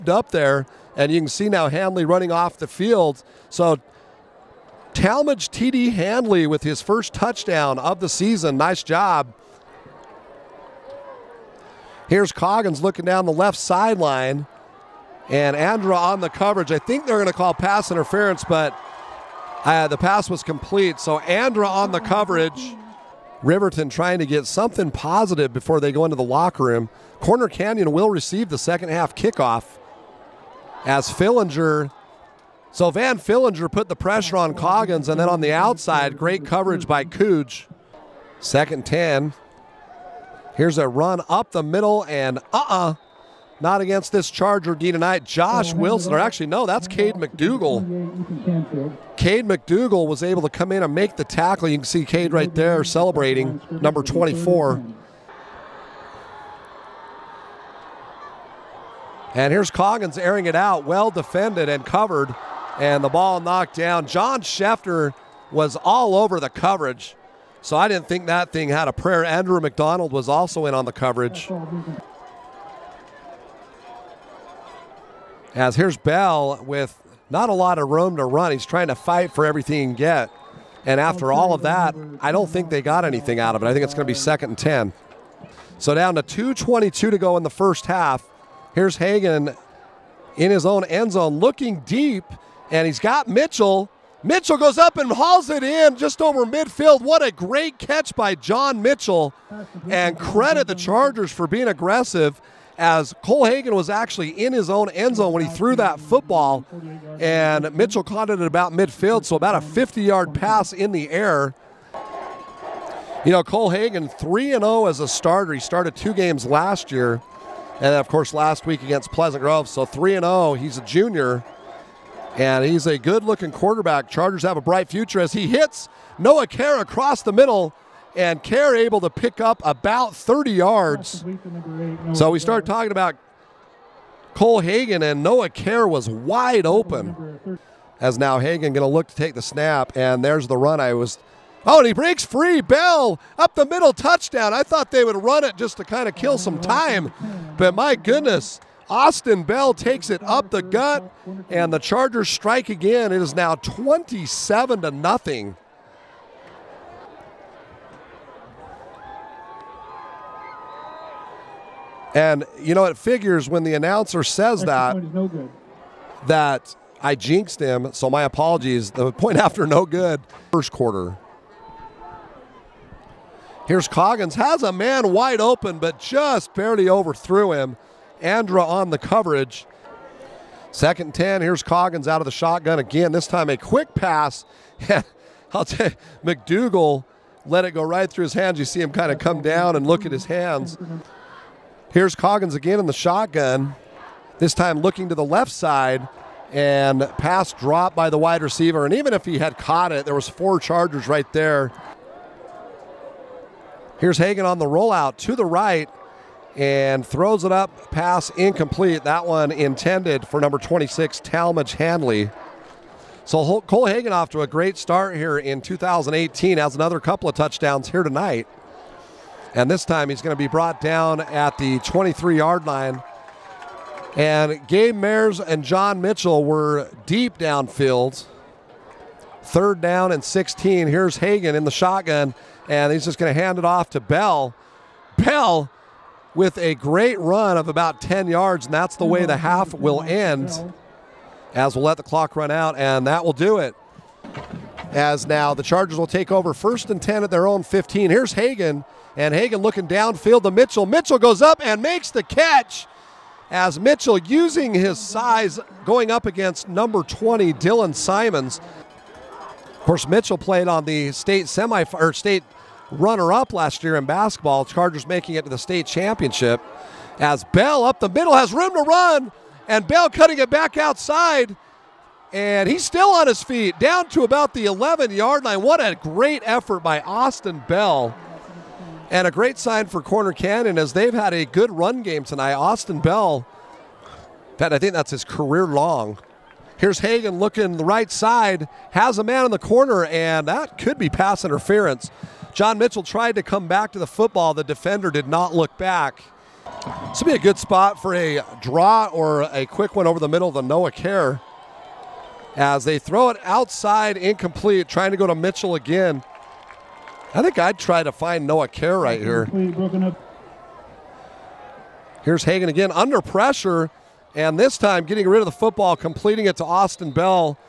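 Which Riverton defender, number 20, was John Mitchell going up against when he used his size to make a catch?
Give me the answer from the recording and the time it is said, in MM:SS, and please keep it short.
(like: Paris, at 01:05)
Dylan Simons, at 04:17.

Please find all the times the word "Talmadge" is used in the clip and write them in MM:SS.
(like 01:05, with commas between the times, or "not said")
00:04, 03:31.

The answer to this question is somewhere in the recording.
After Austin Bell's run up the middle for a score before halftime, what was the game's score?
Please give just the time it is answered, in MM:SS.
02:33.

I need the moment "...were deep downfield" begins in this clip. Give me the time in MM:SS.
03:46.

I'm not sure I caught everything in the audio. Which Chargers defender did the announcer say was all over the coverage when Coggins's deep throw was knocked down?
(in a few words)
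John Scheffner.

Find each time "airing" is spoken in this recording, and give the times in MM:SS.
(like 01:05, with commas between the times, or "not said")
01:00.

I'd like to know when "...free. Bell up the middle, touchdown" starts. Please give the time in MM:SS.
02:22.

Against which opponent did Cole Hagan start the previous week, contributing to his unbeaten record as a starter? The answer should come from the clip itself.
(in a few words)
Pleasant Grove.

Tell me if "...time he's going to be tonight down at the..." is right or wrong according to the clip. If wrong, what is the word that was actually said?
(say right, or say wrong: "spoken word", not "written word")
wrong: "brought", not "tonight".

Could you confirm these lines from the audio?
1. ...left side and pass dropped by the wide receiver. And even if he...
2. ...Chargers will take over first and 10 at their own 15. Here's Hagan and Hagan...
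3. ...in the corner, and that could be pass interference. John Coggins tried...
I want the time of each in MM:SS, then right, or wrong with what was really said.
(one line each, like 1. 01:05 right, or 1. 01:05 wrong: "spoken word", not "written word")
1. 03:15 right
2. 04:05 right
3. 04:49 wrong: "Mitchell", not "Coggins".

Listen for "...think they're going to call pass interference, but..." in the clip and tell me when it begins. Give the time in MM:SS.
00:16.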